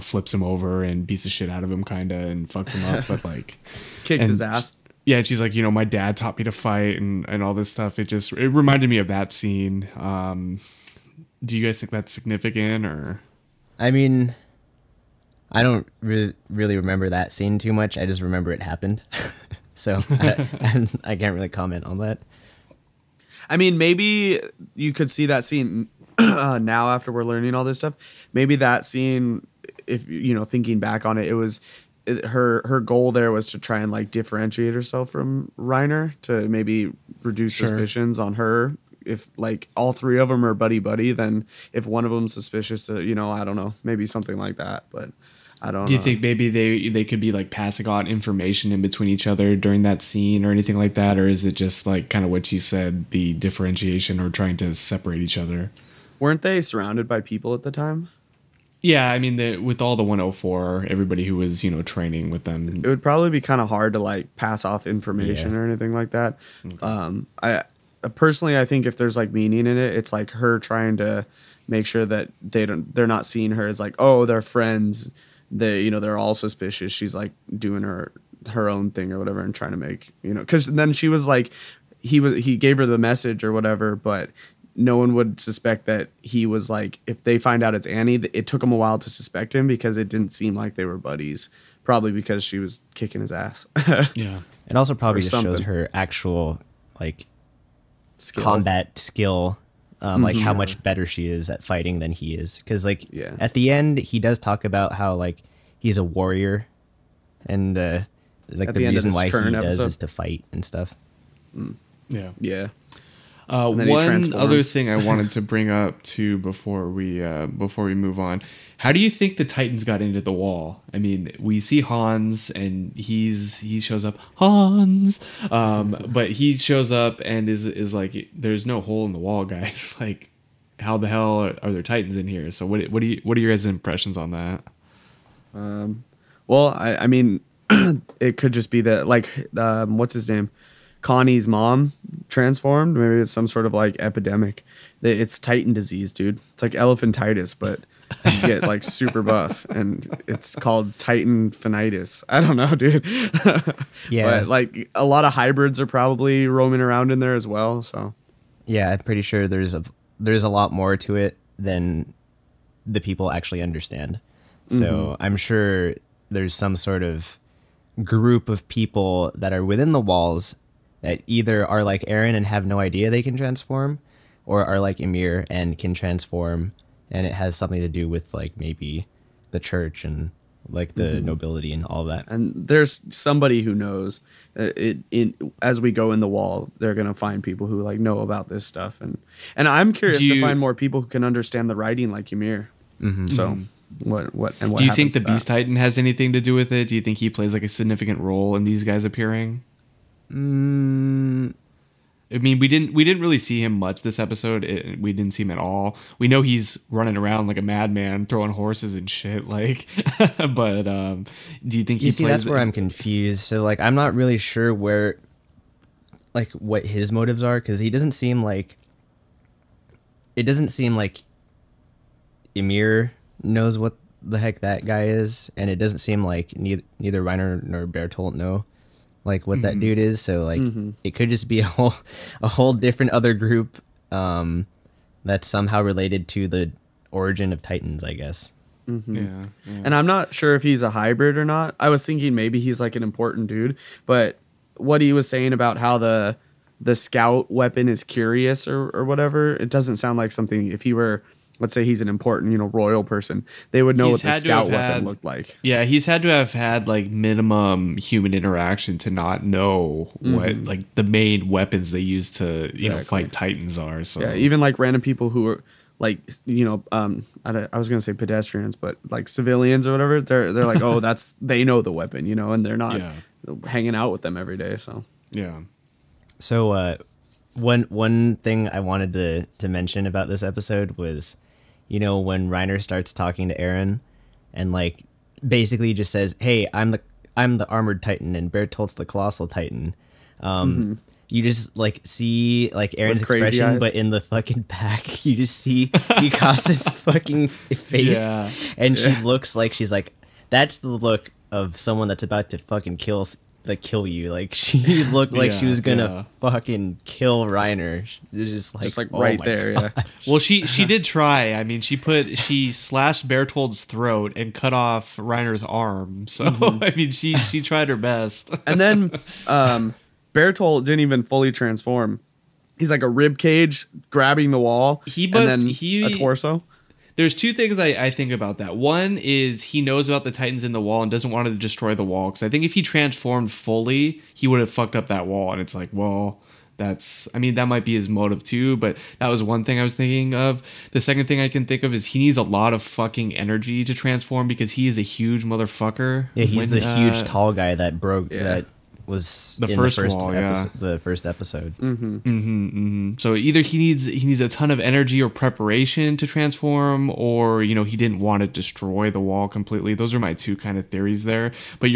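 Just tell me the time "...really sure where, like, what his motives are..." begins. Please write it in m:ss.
3:34.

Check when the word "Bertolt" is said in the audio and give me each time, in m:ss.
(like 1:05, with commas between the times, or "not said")
3:47, 4:48, 5:13, 5:20.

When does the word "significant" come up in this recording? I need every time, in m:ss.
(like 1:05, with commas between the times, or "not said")
0:12, 3:17.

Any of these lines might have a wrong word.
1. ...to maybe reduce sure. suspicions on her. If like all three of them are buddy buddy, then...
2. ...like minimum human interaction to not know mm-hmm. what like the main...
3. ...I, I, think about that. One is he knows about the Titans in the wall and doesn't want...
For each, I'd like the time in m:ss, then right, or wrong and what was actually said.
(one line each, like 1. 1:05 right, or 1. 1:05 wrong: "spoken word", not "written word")
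1. 0:36 right
2. 4:16 right
3. 5:27 right.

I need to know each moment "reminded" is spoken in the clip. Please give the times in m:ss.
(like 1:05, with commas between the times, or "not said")
0:08.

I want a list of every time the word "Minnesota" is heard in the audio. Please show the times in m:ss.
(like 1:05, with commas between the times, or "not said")
not said.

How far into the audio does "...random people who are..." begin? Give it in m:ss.
4:24.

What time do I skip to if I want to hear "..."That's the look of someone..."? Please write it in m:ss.
5:00.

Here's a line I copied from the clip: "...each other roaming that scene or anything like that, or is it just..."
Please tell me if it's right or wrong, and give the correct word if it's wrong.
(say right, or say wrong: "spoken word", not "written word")
wrong: "during", not "roaming".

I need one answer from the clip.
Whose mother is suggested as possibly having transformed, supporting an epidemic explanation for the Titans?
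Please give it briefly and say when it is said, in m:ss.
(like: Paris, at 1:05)
Connie's mom, at 2:21.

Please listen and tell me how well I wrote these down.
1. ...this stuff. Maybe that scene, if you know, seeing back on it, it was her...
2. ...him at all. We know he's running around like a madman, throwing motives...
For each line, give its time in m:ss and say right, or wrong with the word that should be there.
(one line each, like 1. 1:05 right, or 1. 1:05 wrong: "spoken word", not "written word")
1. 0:27 wrong: "thinking", not "seeing"
2. 3:25 wrong: "horses", not "motives".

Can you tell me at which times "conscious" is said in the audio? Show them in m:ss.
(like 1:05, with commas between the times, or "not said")
not said.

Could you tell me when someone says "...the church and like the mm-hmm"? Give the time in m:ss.
2:59.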